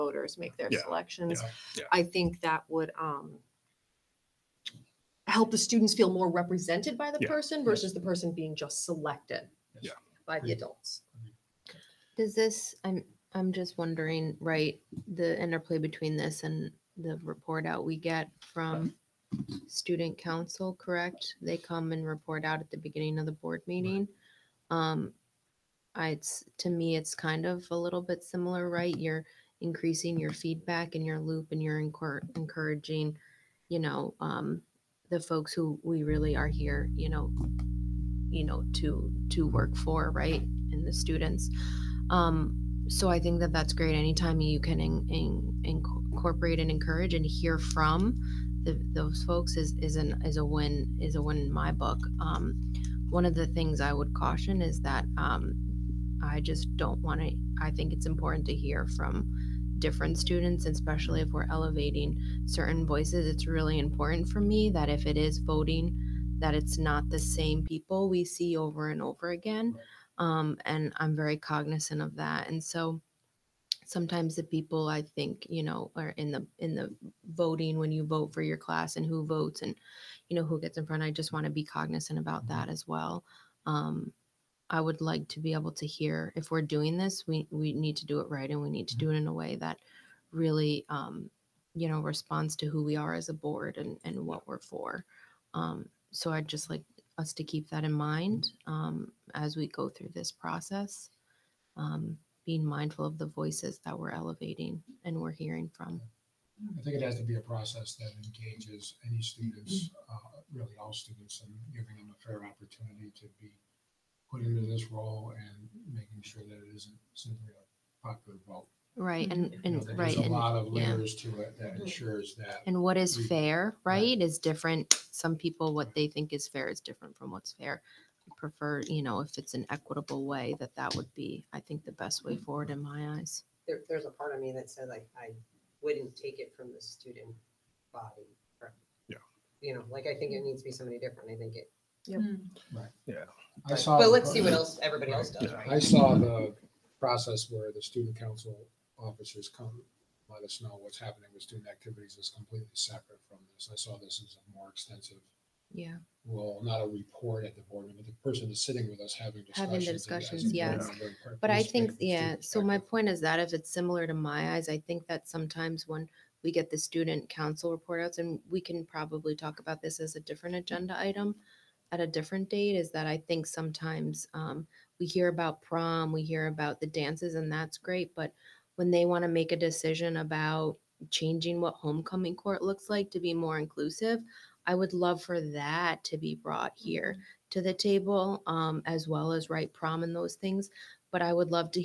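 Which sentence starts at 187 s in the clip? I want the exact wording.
to the table, um, as well as right prom and those things.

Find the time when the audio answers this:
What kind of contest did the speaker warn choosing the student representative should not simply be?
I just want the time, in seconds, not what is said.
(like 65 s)
118 s.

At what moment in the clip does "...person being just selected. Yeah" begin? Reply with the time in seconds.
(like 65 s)
8 s.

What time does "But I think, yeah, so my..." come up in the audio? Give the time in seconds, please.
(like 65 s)
161 s.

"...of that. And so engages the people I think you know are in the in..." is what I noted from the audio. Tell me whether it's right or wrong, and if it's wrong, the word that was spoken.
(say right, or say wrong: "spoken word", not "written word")
wrong: "sometimes", not "engages".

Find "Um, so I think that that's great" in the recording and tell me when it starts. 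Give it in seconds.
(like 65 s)
42 s.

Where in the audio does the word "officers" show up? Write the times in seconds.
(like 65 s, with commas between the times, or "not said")
148 s.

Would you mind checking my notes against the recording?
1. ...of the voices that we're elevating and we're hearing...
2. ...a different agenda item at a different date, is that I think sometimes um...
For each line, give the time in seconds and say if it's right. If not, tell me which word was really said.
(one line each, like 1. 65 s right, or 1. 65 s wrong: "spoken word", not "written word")
1. 103 s right
2. 170 s right.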